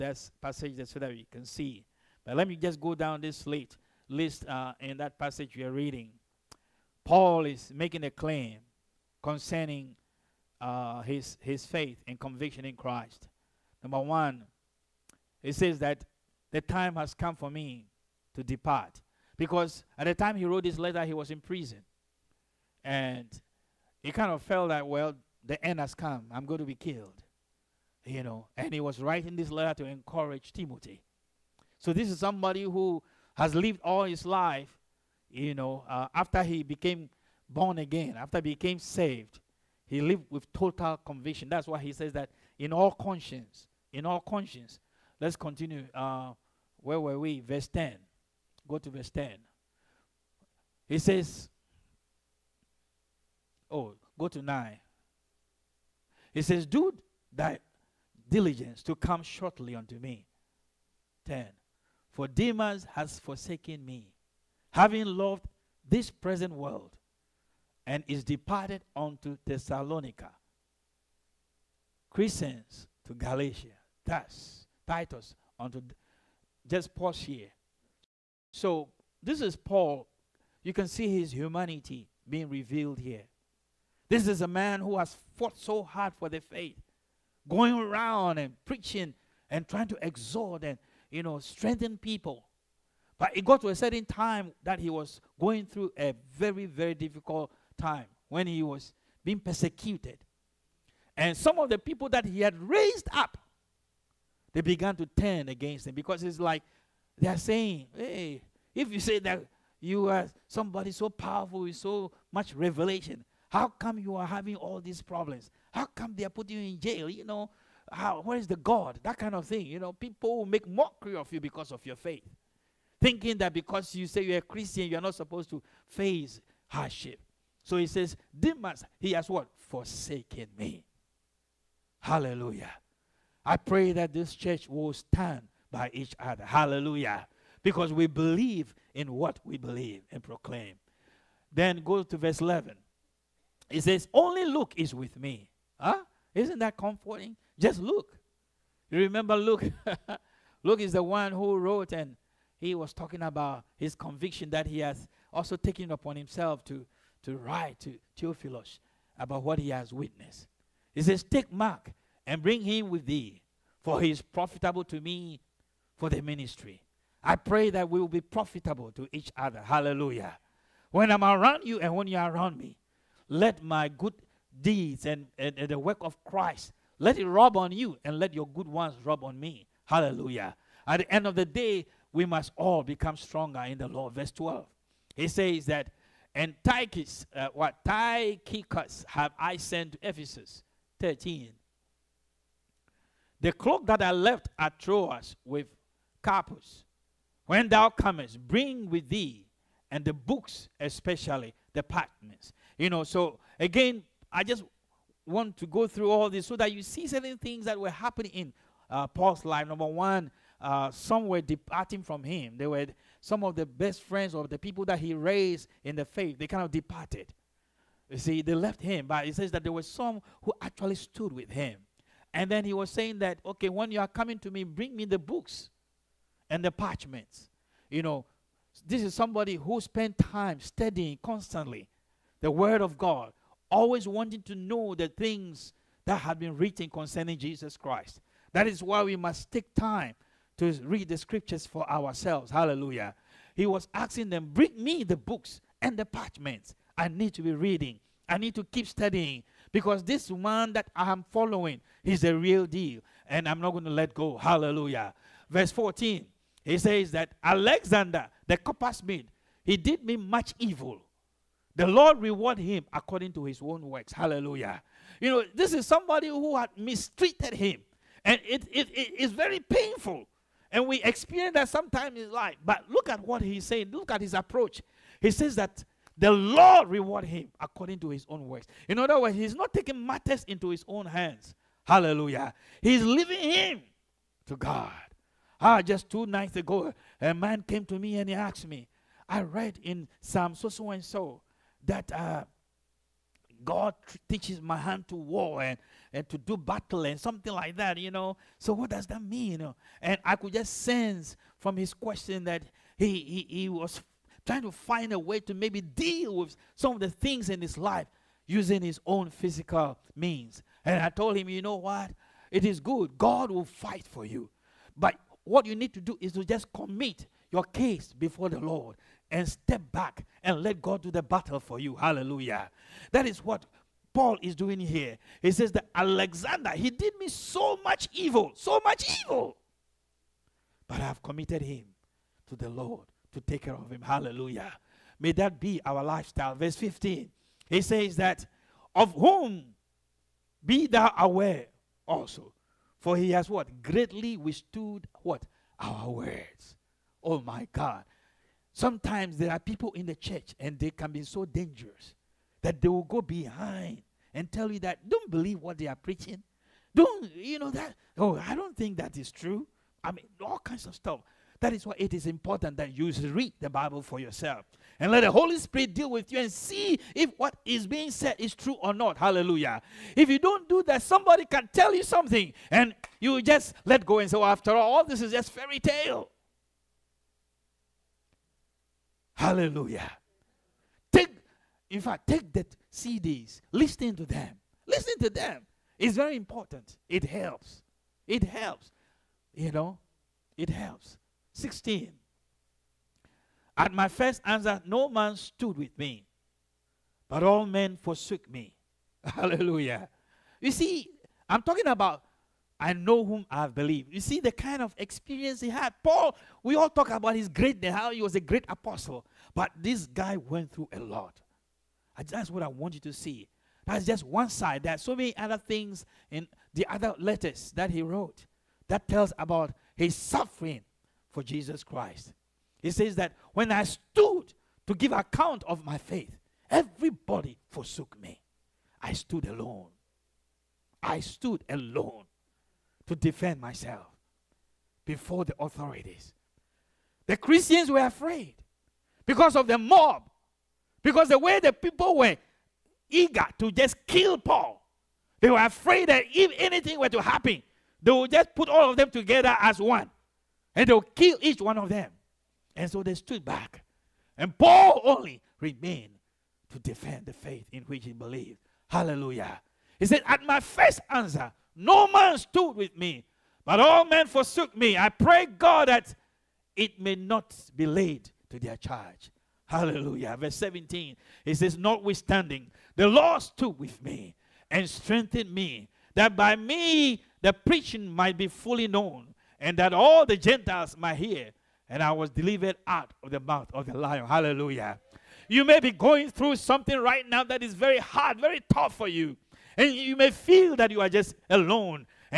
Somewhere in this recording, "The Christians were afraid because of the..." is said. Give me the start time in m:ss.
7:17.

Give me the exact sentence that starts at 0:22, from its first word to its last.
And he kind of felt that, well, the end has come.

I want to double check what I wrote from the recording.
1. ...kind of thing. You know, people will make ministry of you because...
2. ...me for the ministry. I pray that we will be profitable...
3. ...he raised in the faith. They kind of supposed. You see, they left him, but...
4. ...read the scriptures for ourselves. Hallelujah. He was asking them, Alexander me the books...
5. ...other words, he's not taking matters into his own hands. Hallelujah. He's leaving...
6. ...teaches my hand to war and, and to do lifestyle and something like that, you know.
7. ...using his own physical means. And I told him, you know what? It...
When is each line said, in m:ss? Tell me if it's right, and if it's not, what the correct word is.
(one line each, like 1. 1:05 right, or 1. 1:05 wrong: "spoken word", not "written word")
1. 1:59 wrong: "mockery", not "ministry"
2. 2:44 right
3. 3:34 wrong: "departed", not "supposed"
4. 4:00 wrong: "Bring", not "Alexander"
5. 4:38 right
6. 4:54 wrong: "battle", not "lifestyle"
7. 5:08 right.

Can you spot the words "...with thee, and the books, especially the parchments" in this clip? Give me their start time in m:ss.
3:18.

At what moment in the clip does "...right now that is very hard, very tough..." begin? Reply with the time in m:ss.
8:06.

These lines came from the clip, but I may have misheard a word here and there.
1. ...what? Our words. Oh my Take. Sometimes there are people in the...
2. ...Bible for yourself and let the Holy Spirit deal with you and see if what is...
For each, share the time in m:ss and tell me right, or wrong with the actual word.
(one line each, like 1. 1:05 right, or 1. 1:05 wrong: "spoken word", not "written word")
1. 5:45 wrong: "God", not "Take"
2. 6:03 right.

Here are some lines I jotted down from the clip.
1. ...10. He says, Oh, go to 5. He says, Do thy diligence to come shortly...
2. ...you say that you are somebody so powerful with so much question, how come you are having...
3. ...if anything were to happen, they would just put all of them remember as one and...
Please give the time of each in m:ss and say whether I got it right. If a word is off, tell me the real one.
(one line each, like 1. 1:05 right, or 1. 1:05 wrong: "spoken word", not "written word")
1. 0:49 wrong: "9", not "5"
2. 1:48 wrong: "revelation", not "question"
3. 7:26 wrong: "together", not "remember".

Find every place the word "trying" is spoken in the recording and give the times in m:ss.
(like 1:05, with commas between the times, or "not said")
1:29, 5:04.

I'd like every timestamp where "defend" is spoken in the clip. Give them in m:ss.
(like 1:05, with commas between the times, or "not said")
7:13, 7:36.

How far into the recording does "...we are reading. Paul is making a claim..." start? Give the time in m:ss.
0:05.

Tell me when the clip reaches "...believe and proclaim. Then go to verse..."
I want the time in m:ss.
2:19.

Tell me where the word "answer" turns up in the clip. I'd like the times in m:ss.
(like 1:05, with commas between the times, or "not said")
6:34, 7:41.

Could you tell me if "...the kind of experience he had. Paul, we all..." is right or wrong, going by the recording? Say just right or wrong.
right.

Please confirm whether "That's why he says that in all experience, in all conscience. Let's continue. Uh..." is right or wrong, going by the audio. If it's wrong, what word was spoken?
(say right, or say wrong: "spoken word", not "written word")
wrong: "conscience", not "experience".